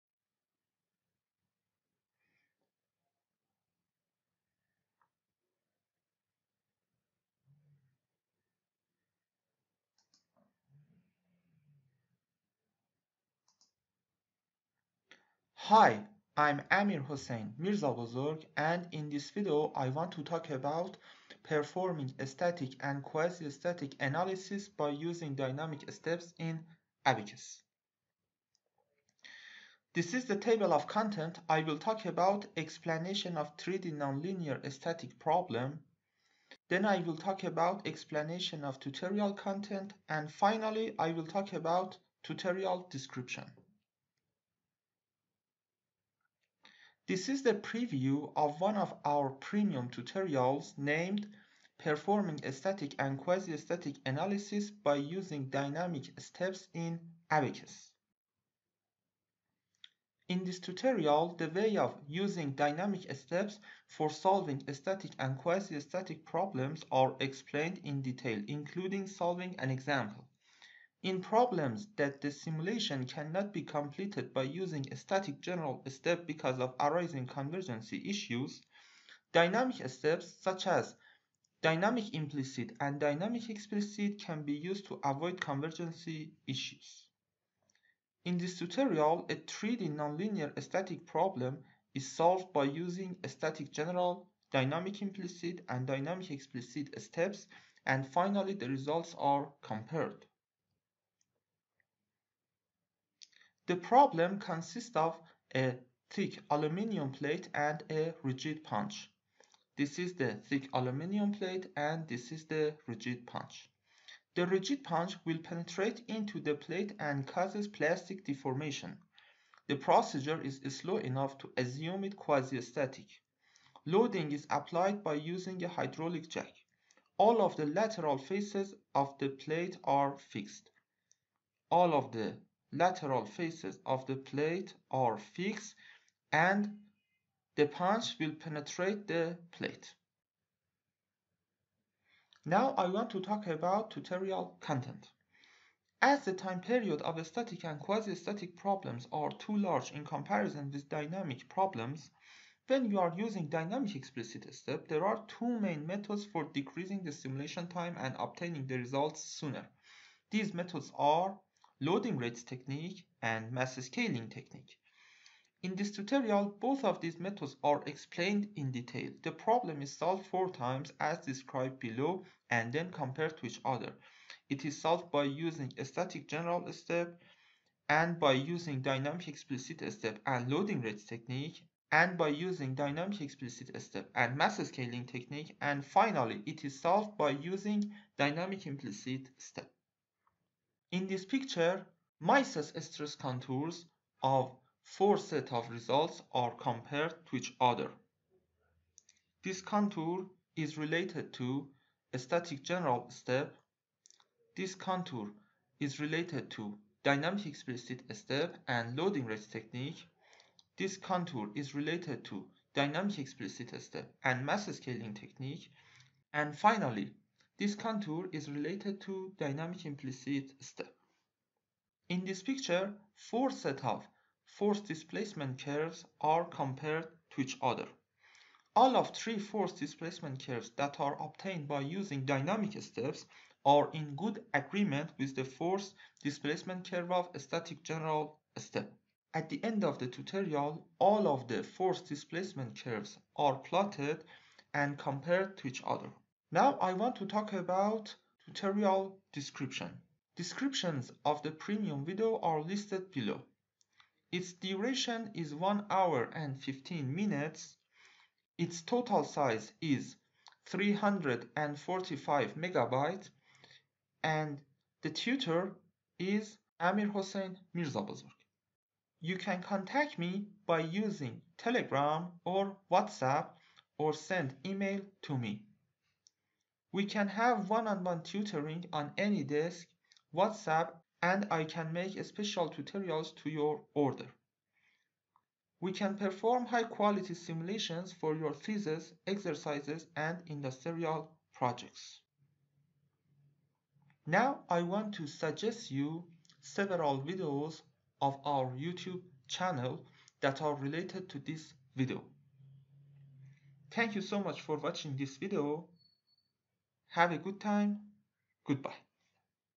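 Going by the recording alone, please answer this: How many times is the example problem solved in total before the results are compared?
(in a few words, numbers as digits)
4.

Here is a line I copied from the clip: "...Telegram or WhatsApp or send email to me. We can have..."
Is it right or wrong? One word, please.
right.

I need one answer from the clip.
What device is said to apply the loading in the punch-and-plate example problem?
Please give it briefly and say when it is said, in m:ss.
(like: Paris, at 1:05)
Hydraulic jack, at 2:05.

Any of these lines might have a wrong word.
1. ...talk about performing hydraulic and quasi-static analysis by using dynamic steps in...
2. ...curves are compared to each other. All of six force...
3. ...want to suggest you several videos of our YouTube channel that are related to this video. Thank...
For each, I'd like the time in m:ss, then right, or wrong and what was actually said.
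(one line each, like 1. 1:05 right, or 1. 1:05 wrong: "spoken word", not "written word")
1. 0:20 wrong: "static", not "hydraulic"
2. 3:45 wrong: "three", not "six"
3. 4:54 right.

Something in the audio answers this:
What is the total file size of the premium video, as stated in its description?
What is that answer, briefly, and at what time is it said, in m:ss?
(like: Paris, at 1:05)
345 megabytes, at 4:20.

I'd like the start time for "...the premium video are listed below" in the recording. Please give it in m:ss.
4:11.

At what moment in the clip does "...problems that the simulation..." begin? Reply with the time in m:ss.
1:11.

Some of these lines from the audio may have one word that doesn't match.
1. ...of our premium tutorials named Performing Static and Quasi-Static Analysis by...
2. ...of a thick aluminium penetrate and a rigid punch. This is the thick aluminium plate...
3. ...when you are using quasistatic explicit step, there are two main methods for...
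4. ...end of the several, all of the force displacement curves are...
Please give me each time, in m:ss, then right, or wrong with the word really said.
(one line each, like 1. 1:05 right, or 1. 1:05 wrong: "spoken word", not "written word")
1. 0:48 right
2. 1:44 wrong: "plate", not "penetrate"
3. 2:32 wrong: "dynamic", not "quasistatic"
4. 3:59 wrong: "tutorial", not "several".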